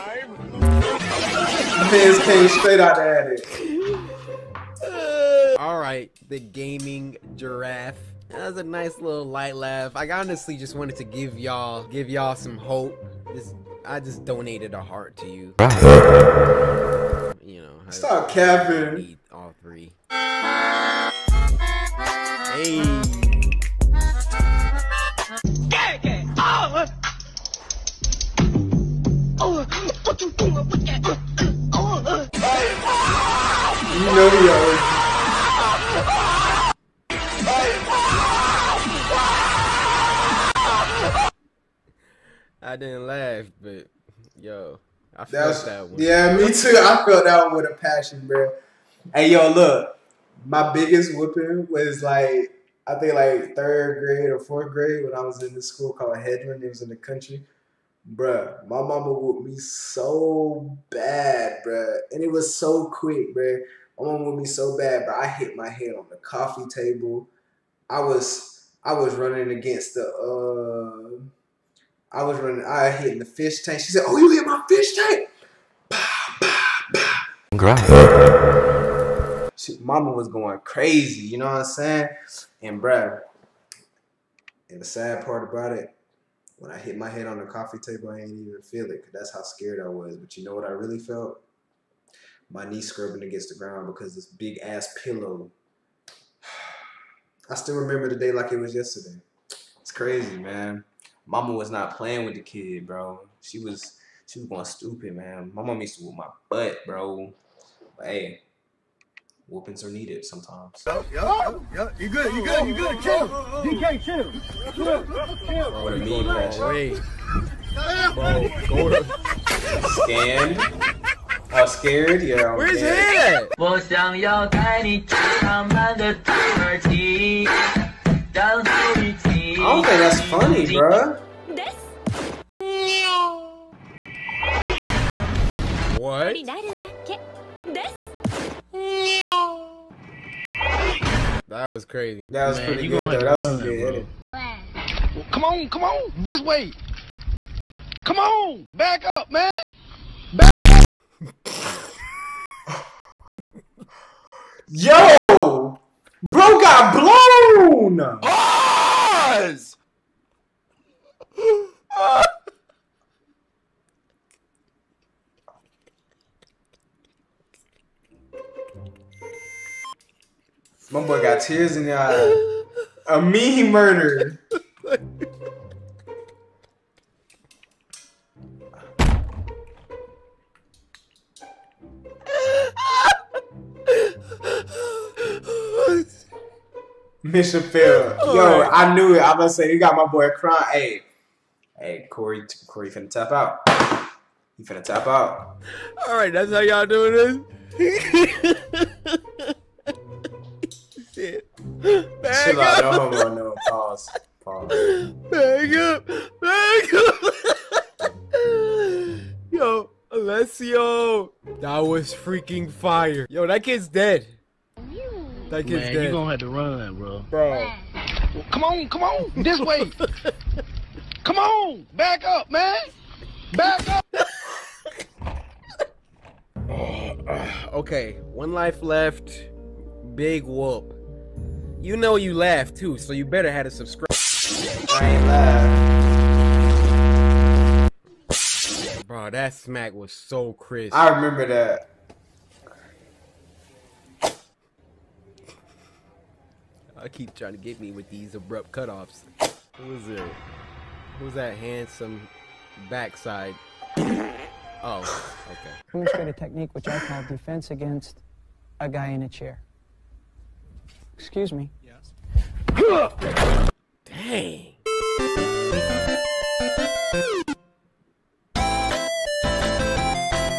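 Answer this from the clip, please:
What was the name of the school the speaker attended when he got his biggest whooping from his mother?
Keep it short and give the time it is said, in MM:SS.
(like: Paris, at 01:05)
Hedron, at 00:56.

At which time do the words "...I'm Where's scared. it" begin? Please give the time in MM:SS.
02:02.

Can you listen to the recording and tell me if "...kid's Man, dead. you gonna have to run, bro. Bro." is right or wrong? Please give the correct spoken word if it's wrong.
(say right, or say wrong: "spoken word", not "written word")
right.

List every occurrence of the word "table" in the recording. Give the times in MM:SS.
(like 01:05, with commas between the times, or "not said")
01:06, 01:27.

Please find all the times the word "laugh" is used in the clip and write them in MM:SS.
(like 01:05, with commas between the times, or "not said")
00:09, 00:43, 03:52.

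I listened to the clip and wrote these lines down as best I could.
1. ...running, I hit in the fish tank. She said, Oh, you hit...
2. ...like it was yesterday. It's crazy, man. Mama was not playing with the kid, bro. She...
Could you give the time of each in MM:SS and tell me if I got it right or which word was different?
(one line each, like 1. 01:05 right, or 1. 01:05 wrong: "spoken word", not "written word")
1. 01:12 right
2. 01:38 right.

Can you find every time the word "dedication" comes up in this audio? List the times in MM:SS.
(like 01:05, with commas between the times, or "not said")
not said.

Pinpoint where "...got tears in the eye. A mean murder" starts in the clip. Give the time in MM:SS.
02:51.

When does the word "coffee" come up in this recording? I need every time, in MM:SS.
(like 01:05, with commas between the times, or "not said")
01:06, 01:27.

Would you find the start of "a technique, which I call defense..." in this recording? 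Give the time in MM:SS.
04:16.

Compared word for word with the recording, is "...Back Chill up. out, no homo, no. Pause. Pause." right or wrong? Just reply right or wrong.
right.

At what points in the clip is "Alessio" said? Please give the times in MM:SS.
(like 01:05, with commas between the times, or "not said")
03:30.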